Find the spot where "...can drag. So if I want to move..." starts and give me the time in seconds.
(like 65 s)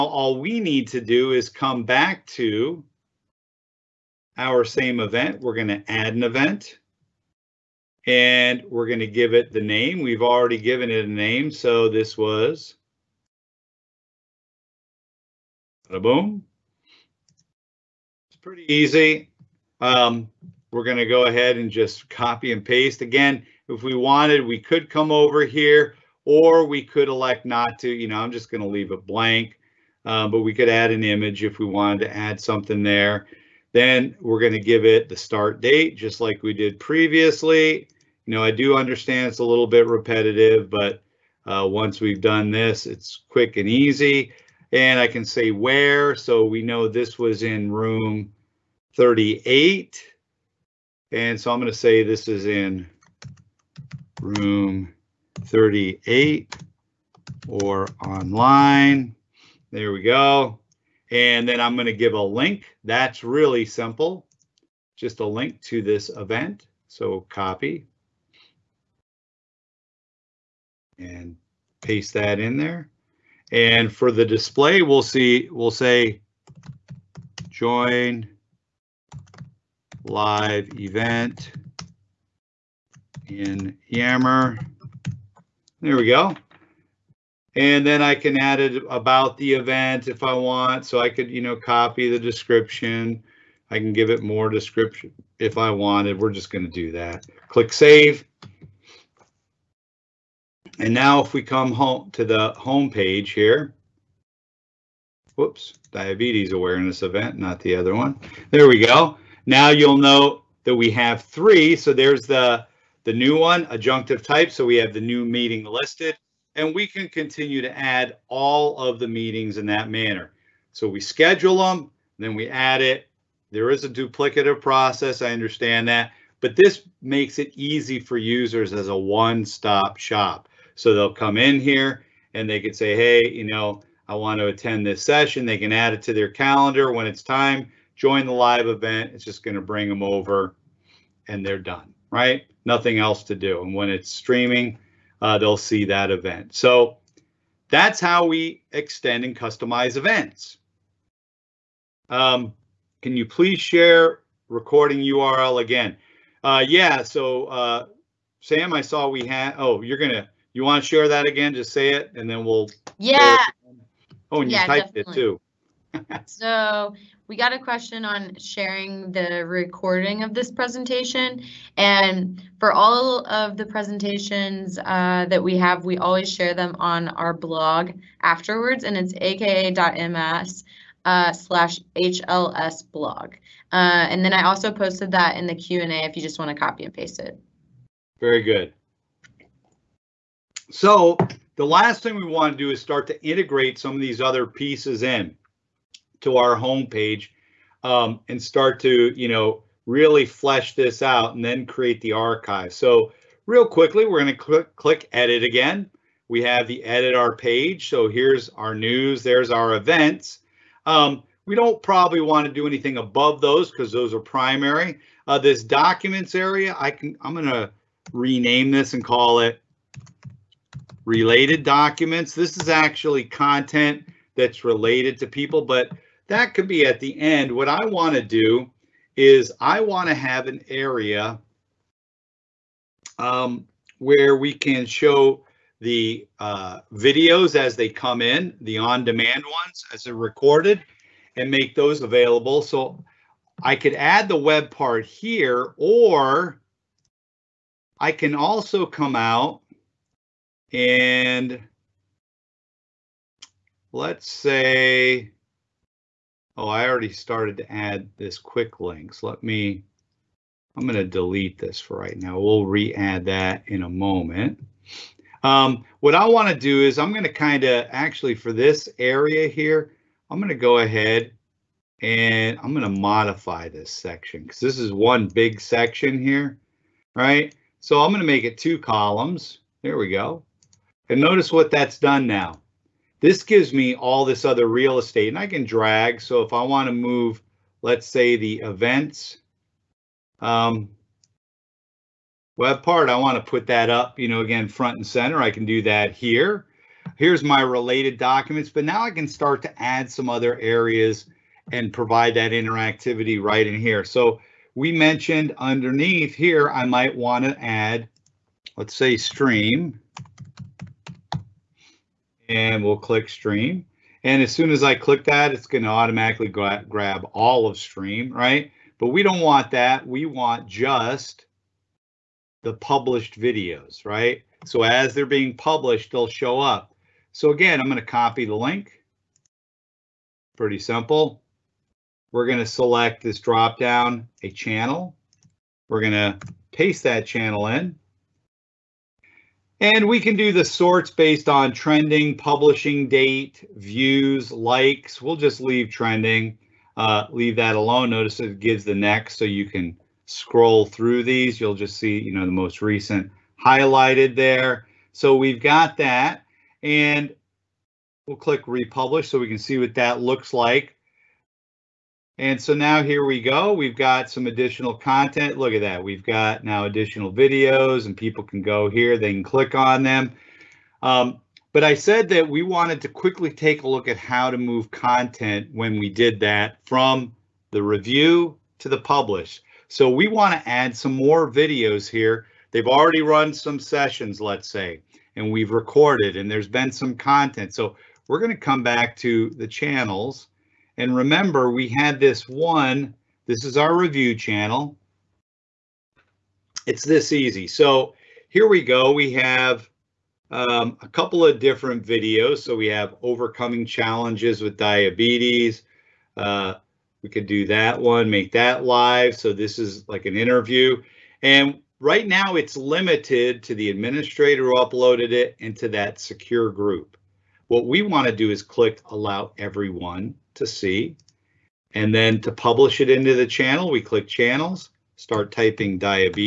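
285 s.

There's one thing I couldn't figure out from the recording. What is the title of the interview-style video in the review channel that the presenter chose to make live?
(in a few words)
Overcoming challenges with diabetes.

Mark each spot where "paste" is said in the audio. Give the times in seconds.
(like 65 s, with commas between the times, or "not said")
22 s, 71 s, 186 s, 336 s.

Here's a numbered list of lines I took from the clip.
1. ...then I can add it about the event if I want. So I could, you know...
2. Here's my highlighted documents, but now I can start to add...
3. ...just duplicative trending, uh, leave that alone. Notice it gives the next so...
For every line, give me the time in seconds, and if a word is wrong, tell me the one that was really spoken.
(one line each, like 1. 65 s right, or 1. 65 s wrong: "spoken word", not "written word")
1. 87 s right
2. 297 s wrong: "related", not "highlighted"
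3. 345 s wrong: "leave", not "duplicative".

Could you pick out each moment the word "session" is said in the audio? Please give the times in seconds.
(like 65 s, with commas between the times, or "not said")
135 s, 383 s.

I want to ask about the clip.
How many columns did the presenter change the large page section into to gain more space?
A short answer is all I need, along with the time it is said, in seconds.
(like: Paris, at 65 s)
2, at 278 s.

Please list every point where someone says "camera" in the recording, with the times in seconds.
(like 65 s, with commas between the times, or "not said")
not said.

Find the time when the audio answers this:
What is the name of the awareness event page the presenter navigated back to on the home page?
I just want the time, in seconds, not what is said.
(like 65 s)
105 s.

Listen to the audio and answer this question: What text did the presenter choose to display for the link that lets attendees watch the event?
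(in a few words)
Join live event in Yammer.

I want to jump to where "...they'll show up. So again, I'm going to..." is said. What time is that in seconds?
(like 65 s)
326 s.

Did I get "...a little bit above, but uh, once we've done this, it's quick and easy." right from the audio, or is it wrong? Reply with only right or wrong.
wrong.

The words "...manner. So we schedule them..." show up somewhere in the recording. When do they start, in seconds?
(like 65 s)
119 s.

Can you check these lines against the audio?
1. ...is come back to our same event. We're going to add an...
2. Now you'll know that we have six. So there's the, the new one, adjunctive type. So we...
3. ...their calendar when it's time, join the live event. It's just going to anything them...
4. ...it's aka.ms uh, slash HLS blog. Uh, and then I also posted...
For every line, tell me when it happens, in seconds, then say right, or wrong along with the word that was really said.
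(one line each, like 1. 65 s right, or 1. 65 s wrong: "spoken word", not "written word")
1. 1 s right
2. 109 s wrong: "three", not "six"
3. 136 s wrong: "bring", not "anything"
4. 178 s right.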